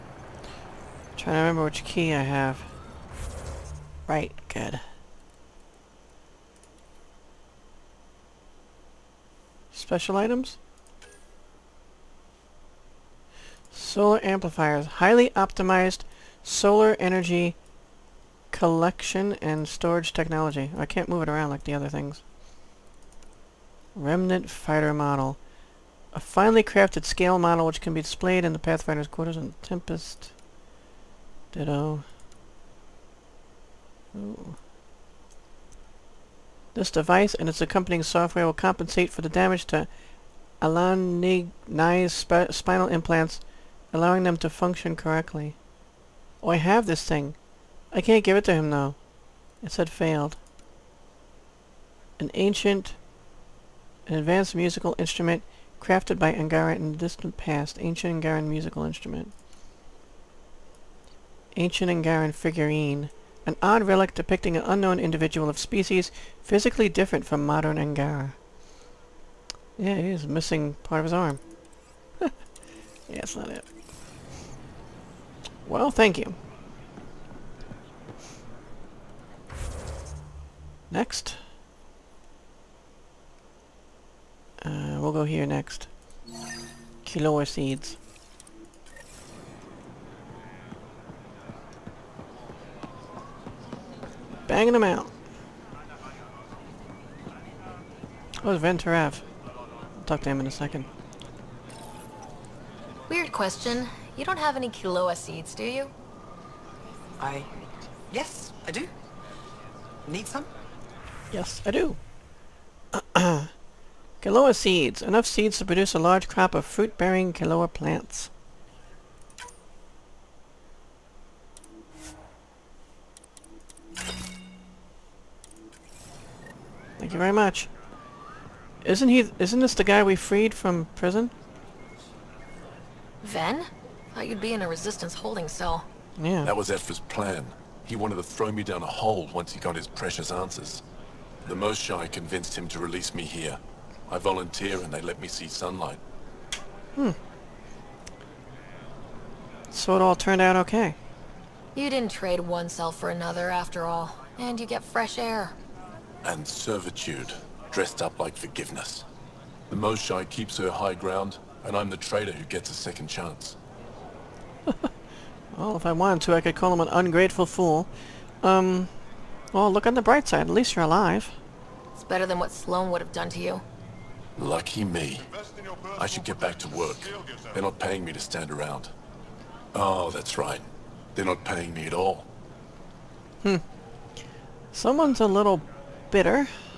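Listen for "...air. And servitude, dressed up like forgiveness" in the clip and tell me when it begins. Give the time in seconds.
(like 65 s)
155 s.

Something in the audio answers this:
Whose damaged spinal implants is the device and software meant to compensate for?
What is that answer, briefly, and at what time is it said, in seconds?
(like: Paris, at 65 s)
Alan Nye, at 40 s.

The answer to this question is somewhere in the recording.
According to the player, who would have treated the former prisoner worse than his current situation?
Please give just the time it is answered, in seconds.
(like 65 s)
172 s.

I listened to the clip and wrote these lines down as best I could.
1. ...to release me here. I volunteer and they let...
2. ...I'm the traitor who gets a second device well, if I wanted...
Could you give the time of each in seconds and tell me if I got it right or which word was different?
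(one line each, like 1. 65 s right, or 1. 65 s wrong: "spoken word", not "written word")
1. 142 s right
2. 161 s wrong: "chance", not "device".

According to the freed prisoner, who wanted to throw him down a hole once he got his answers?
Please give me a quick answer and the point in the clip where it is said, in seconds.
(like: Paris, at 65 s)
Evfra, at 136 s.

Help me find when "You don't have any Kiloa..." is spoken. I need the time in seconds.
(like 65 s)
104 s.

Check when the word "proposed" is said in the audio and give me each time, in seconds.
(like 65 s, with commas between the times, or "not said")
not said.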